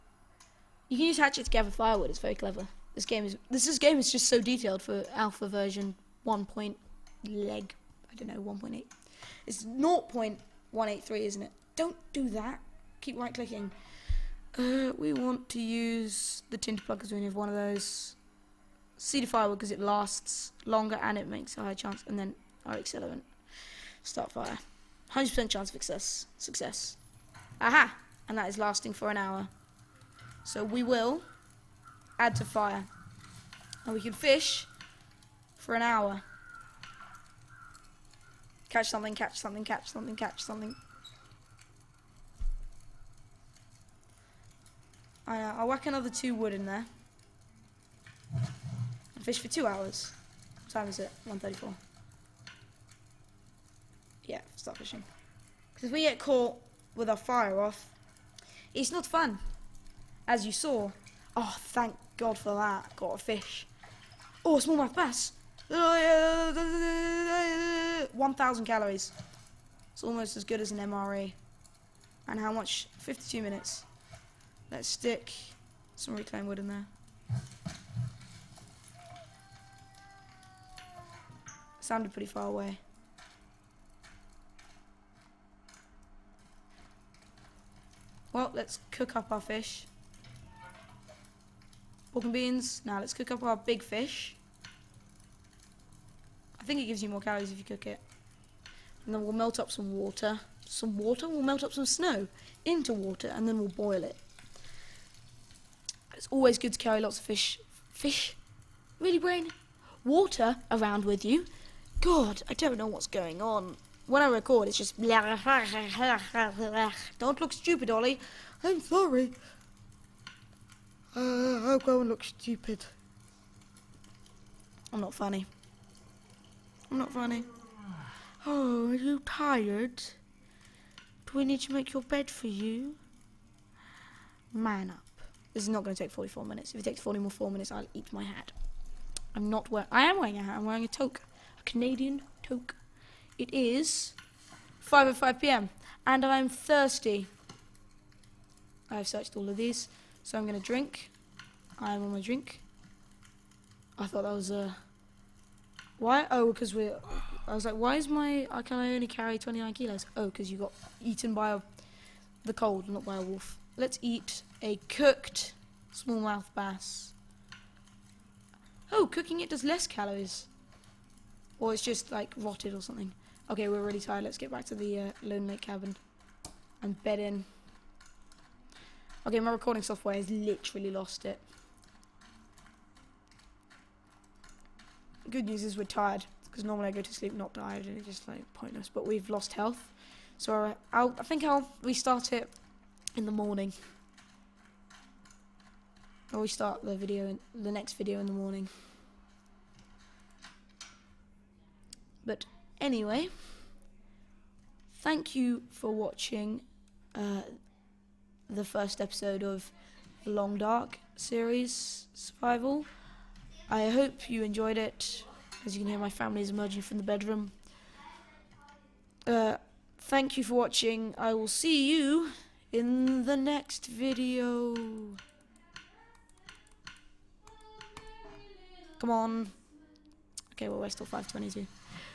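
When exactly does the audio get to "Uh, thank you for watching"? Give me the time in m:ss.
3:39.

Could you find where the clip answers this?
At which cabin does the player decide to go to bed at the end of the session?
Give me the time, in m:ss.
2:55.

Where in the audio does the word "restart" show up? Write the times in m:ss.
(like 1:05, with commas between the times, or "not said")
3:11, 3:16.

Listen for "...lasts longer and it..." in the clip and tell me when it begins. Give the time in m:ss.
0:19.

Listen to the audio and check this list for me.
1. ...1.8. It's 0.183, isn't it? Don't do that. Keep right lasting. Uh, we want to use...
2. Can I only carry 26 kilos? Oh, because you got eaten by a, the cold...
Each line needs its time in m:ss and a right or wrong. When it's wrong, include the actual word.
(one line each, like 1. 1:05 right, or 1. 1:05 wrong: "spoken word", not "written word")
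1. 0:08 wrong: "clicking", not "lasting"
2. 2:38 wrong: "29", not "26".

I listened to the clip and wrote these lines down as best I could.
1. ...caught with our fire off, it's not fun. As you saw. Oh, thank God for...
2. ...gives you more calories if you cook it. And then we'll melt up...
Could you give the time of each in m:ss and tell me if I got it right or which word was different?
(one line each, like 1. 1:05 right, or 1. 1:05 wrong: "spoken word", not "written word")
1. 0:56 right
2. 1:36 right.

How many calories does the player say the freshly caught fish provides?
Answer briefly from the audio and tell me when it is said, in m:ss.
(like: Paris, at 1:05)
1,000, at 1:05.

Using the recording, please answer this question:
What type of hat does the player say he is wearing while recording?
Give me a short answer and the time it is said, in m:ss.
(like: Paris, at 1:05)
Canadian toque, at 2:21.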